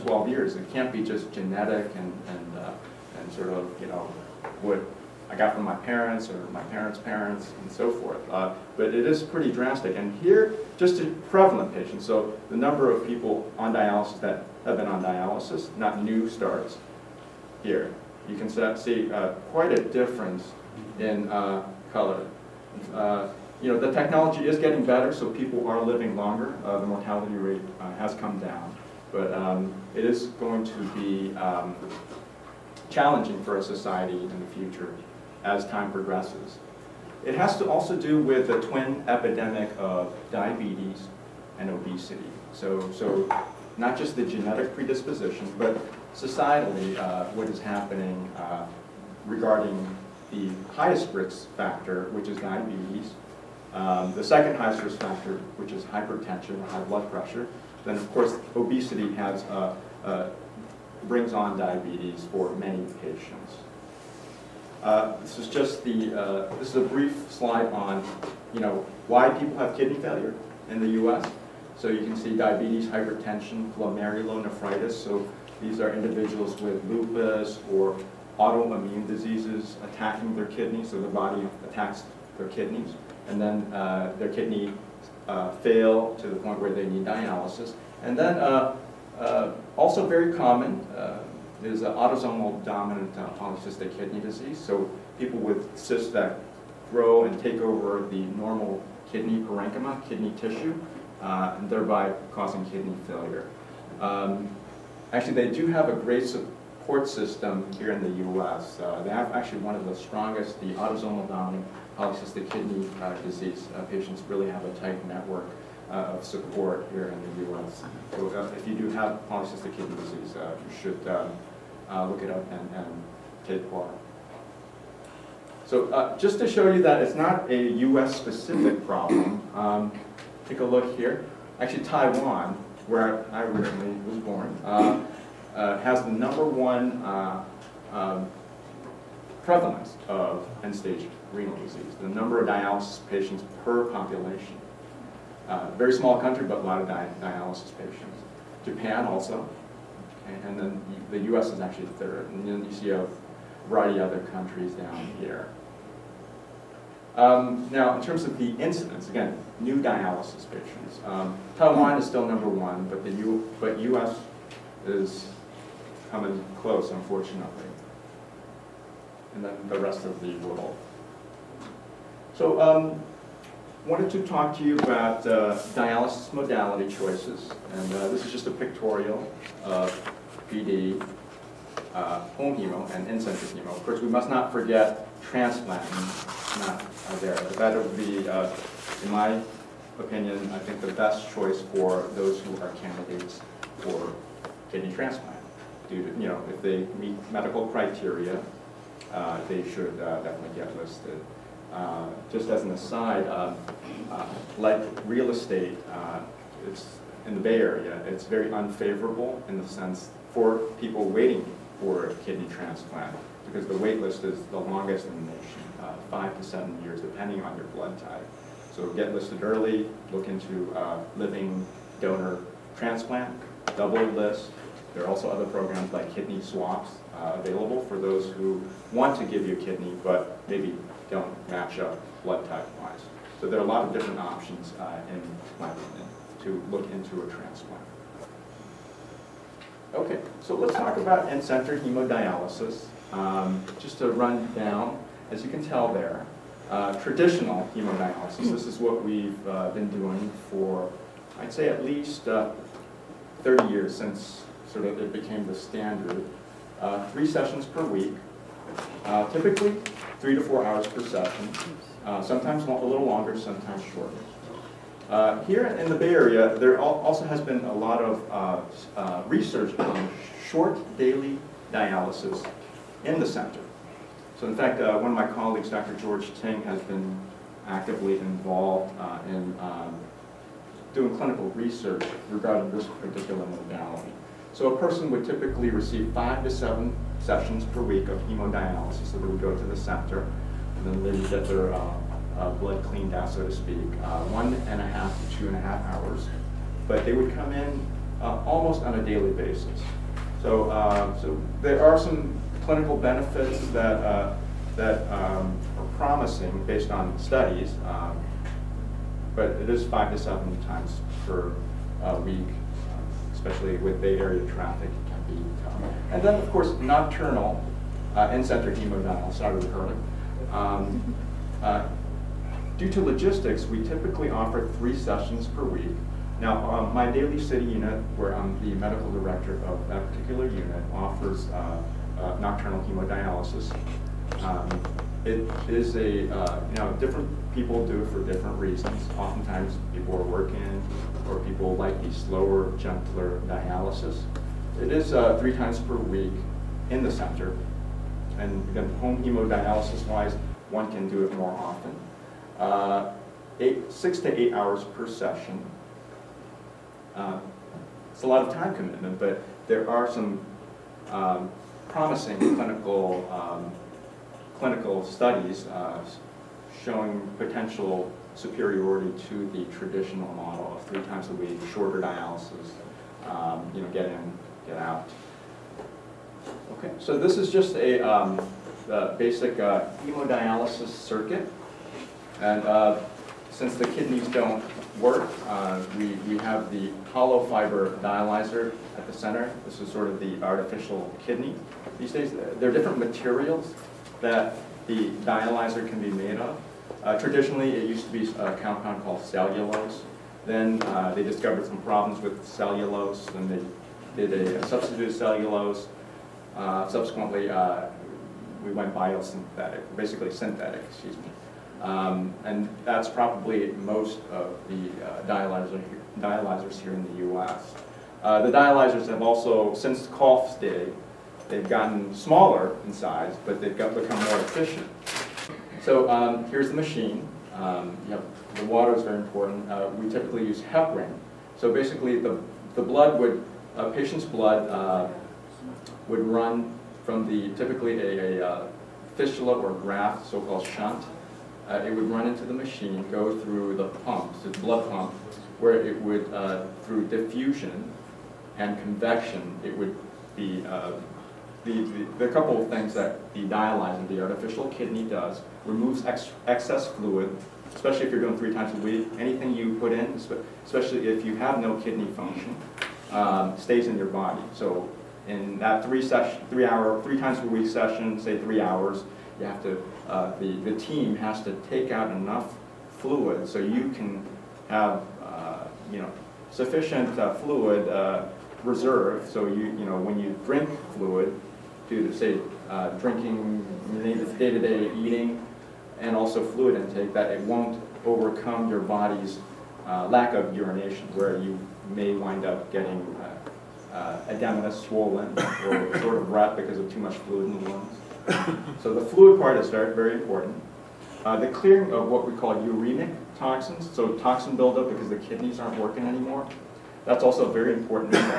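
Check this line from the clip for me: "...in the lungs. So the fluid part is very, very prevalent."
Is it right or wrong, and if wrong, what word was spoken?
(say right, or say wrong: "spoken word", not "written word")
wrong: "important", not "prevalent".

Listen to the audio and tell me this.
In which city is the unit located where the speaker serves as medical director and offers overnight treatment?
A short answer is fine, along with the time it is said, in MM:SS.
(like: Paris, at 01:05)
Daly City, at 05:27.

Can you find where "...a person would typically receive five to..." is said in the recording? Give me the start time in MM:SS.
04:44.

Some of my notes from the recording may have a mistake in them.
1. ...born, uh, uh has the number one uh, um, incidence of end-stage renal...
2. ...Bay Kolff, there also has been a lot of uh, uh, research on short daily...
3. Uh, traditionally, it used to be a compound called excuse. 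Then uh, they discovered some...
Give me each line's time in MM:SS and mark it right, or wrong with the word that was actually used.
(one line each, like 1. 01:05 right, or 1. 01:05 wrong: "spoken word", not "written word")
1. 02:14 wrong: "prevalence", not "incidence"
2. 04:25 wrong: "Area", not "Kolff"
3. 06:37 wrong: "cellulose", not "excuse".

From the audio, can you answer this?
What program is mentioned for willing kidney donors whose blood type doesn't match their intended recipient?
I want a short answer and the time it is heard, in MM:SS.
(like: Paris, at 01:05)
kidney swaps, at 03:46.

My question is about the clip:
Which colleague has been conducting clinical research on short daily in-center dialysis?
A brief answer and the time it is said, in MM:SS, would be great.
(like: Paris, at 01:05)
Dr. George Ting, at 04:35.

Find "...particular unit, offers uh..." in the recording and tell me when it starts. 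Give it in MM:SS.
05:30.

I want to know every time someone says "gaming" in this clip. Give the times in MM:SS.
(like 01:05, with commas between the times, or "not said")
not said.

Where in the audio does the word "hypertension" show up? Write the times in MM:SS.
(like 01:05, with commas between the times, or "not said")
00:55, 01:12.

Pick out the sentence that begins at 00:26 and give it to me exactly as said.
Uh, the mortality rate uh, has come down.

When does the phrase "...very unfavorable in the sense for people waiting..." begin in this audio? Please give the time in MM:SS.
03:28.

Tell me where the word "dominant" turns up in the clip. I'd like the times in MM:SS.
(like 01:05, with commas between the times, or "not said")
01:32, 01:51.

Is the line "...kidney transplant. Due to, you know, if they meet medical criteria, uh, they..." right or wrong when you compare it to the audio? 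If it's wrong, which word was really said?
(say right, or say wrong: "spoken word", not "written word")
right.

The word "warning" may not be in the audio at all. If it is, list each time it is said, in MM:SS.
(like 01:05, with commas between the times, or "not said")
not said.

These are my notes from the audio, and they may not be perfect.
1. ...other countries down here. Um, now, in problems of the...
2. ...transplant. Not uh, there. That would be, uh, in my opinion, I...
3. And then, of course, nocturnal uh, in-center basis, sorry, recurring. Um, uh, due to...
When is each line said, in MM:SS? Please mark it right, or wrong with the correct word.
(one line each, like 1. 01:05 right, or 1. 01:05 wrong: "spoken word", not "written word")
1. 02:34 wrong: "terms", not "problems"
2. 03:05 right
3. 05:16 wrong: "hemodialysis", not "basis".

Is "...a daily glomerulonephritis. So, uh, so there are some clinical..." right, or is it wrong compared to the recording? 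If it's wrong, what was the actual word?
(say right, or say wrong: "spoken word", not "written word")
wrong: "basis", not "glomerulonephritis".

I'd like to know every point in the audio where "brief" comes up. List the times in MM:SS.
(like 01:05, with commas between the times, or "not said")
01:06.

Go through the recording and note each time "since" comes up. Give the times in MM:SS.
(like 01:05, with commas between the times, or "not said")
04:13, 06:23, 06:59.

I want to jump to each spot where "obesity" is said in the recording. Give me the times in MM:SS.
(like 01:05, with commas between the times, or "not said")
00:41, 00:58.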